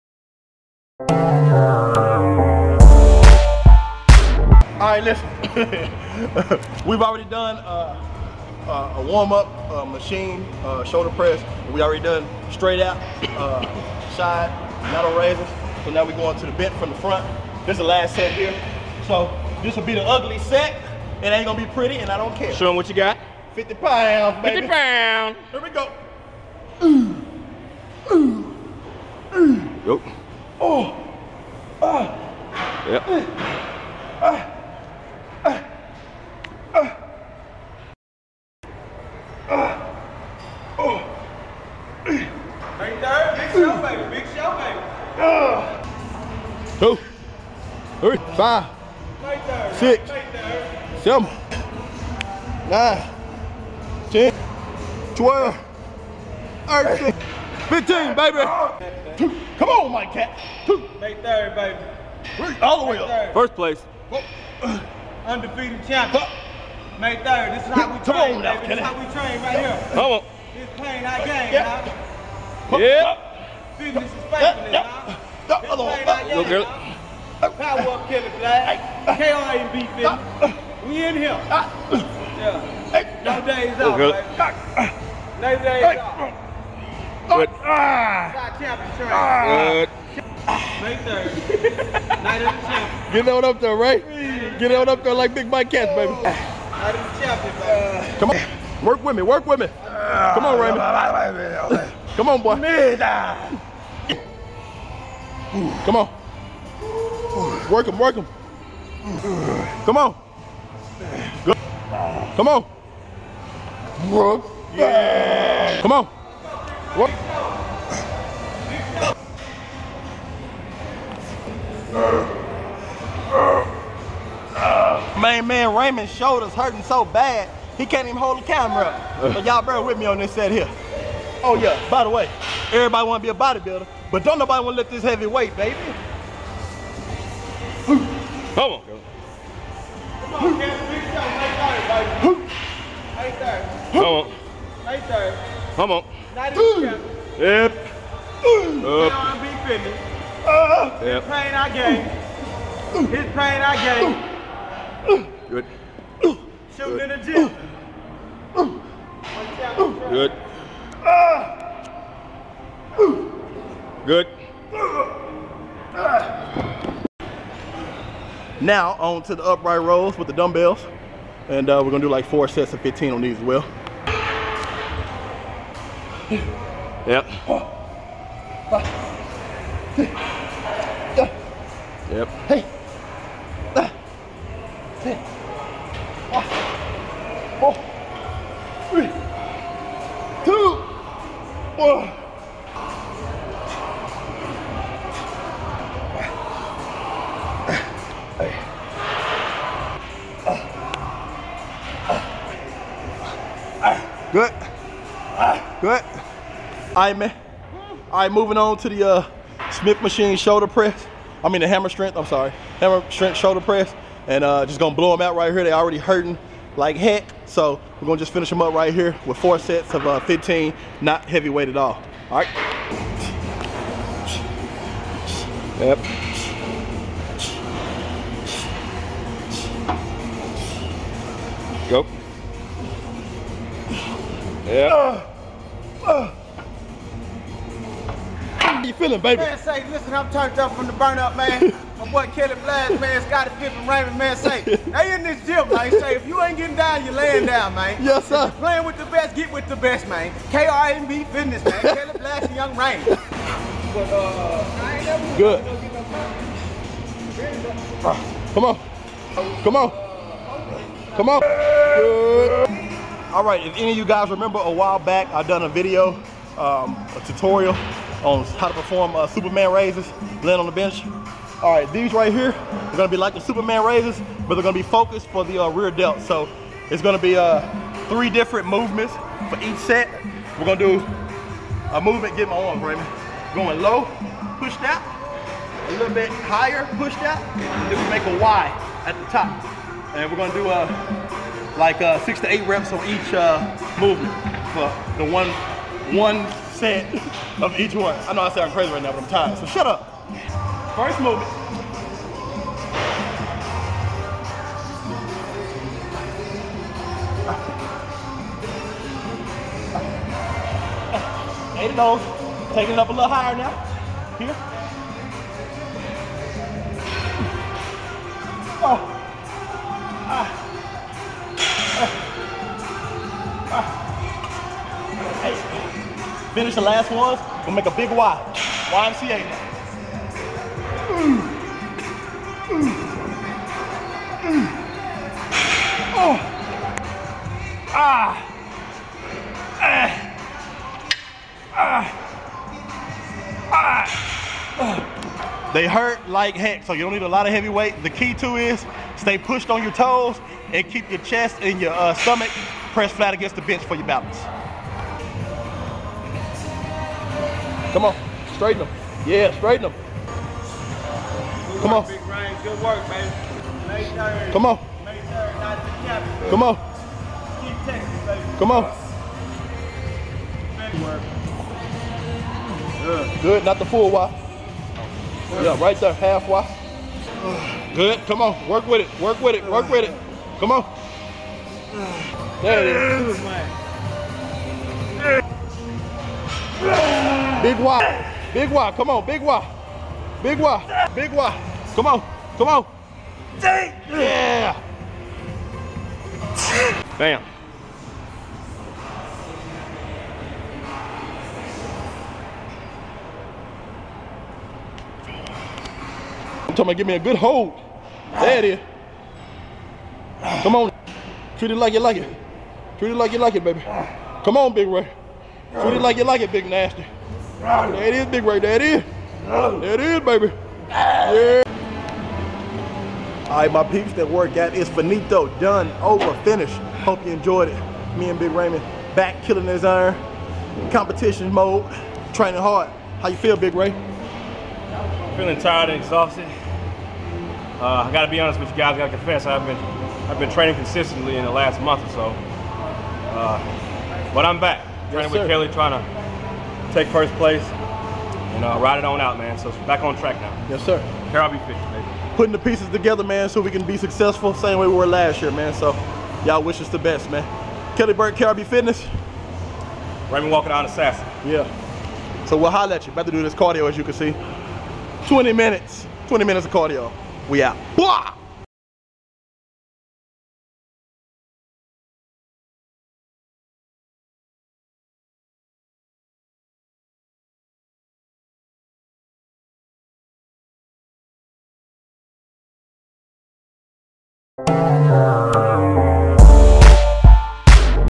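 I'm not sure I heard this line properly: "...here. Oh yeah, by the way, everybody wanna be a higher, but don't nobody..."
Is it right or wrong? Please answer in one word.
wrong.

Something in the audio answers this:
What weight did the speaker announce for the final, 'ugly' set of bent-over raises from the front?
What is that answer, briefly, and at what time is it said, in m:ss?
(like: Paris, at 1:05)
50 pounds, at 0:23.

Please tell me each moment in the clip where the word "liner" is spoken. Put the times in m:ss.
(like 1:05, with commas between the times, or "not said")
not said.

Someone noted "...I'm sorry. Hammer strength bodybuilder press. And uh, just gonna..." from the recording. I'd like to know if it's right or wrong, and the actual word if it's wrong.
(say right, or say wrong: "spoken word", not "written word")
wrong: "shoulder", not "bodybuilder".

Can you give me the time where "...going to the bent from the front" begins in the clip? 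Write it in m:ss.
0:16.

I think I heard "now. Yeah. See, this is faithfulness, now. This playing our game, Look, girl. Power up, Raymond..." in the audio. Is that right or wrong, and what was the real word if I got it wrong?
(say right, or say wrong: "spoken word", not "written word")
wrong: "Kelly", not "Raymond".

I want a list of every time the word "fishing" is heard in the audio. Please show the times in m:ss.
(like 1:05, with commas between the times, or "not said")
7:31.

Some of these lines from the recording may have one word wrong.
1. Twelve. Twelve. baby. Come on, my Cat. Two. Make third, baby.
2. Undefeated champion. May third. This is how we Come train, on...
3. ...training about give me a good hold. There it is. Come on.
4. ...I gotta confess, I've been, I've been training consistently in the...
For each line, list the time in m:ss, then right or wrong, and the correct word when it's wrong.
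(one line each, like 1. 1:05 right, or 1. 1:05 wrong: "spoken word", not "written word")
1. 0:54 wrong: "Ten", not "Twelve"
2. 1:05 right
3. 6:46 wrong: "talking", not "training"
4. 7:18 right.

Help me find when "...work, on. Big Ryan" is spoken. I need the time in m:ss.
6:01.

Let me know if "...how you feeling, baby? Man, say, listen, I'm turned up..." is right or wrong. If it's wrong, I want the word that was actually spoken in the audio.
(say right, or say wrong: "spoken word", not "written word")
right.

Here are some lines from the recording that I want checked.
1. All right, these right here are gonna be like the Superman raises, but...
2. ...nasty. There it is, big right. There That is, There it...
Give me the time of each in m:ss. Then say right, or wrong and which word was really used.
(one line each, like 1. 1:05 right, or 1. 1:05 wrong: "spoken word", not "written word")
1. 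4:31 right
2. 6:56 right.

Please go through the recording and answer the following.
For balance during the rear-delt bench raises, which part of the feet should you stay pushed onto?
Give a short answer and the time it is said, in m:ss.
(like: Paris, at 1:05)
Toes, at 5:49.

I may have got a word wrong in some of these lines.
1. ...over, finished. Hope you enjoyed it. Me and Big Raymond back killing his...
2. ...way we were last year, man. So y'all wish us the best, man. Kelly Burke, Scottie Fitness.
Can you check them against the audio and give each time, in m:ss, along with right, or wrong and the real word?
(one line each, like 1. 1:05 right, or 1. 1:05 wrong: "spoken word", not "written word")
1. 7:06 right
2. 7:34 wrong: "KRB", not "Scottie".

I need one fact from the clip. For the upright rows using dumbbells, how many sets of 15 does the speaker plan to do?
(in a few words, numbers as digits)
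4.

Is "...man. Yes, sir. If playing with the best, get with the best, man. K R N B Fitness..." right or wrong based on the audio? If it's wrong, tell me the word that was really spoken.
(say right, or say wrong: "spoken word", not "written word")
right.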